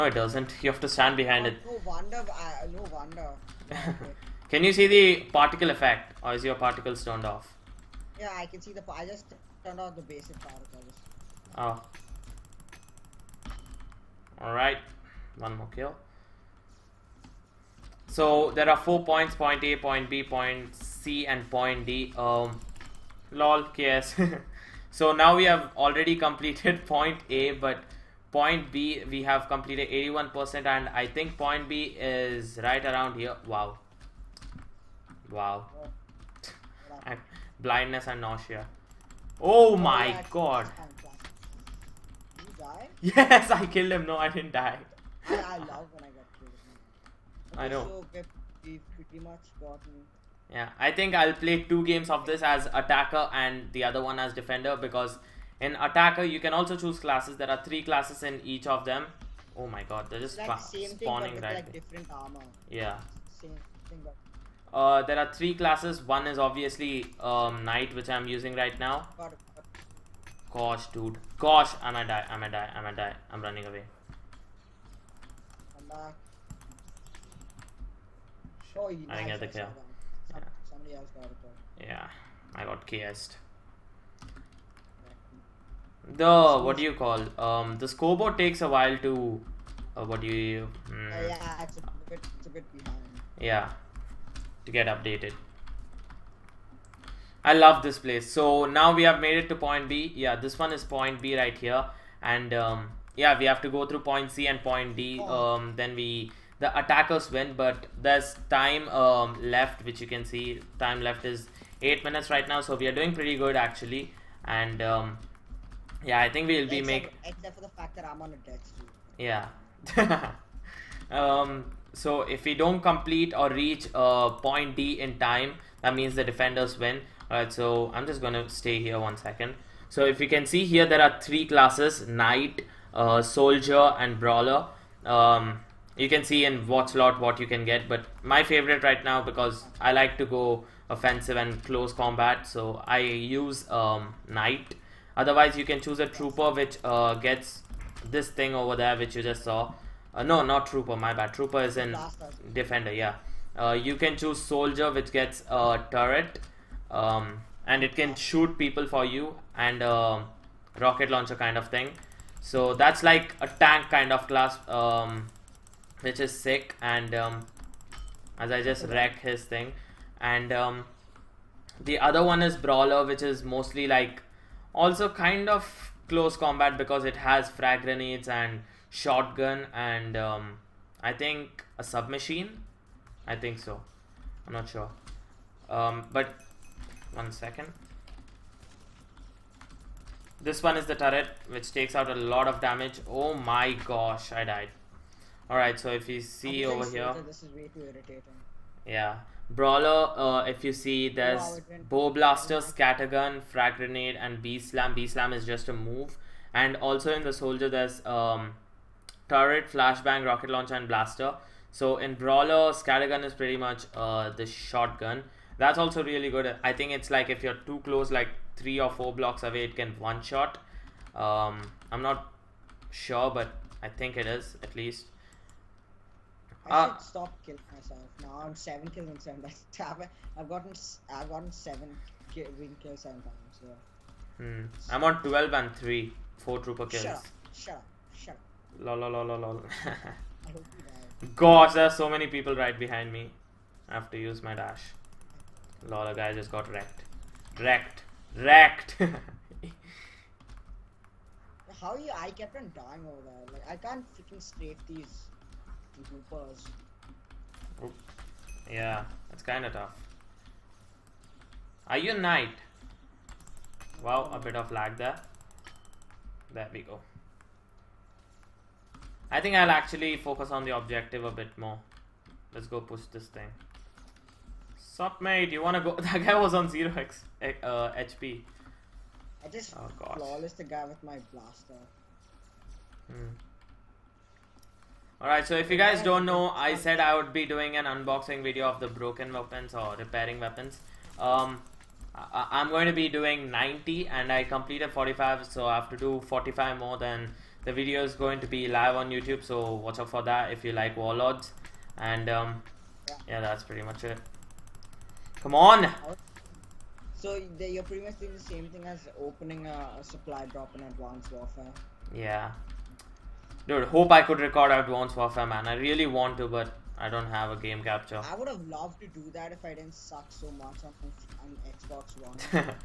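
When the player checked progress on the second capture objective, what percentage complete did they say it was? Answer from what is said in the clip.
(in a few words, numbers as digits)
81%.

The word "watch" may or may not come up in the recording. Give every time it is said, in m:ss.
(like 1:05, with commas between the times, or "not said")
4:59.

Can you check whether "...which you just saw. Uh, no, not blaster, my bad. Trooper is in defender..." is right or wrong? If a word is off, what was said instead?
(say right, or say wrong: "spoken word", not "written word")
wrong: "trooper", not "blaster".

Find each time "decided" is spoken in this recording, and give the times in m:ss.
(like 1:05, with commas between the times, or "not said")
not said.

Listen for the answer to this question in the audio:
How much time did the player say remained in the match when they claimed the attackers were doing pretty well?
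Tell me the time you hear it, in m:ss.
1:51.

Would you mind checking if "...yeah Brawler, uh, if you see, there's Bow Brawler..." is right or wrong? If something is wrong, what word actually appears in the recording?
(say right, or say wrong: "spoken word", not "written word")
wrong: "Blaster", not "Brawler".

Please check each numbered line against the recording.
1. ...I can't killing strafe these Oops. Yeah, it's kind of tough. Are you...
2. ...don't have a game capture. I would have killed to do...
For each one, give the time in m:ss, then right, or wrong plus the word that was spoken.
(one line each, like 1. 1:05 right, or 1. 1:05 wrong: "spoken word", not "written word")
1. 4:13 wrong: "freaking", not "killing"
2. 5:17 wrong: "loved", not "killed".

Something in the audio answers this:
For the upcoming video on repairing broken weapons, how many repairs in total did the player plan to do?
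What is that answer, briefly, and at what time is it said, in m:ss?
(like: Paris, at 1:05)
90, at 4:53.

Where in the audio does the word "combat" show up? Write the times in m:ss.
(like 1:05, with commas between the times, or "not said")
2:21, 2:56.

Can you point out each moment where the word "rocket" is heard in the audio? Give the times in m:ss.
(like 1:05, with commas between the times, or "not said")
2:40, 3:30.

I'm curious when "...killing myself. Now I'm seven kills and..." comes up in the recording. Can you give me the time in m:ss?
3:47.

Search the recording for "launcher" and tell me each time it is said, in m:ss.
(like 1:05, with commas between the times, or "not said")
2:41, 3:30.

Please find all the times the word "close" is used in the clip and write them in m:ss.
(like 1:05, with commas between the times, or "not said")
2:21, 2:56, 3:37.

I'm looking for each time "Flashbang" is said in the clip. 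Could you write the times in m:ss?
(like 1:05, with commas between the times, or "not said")
3:29.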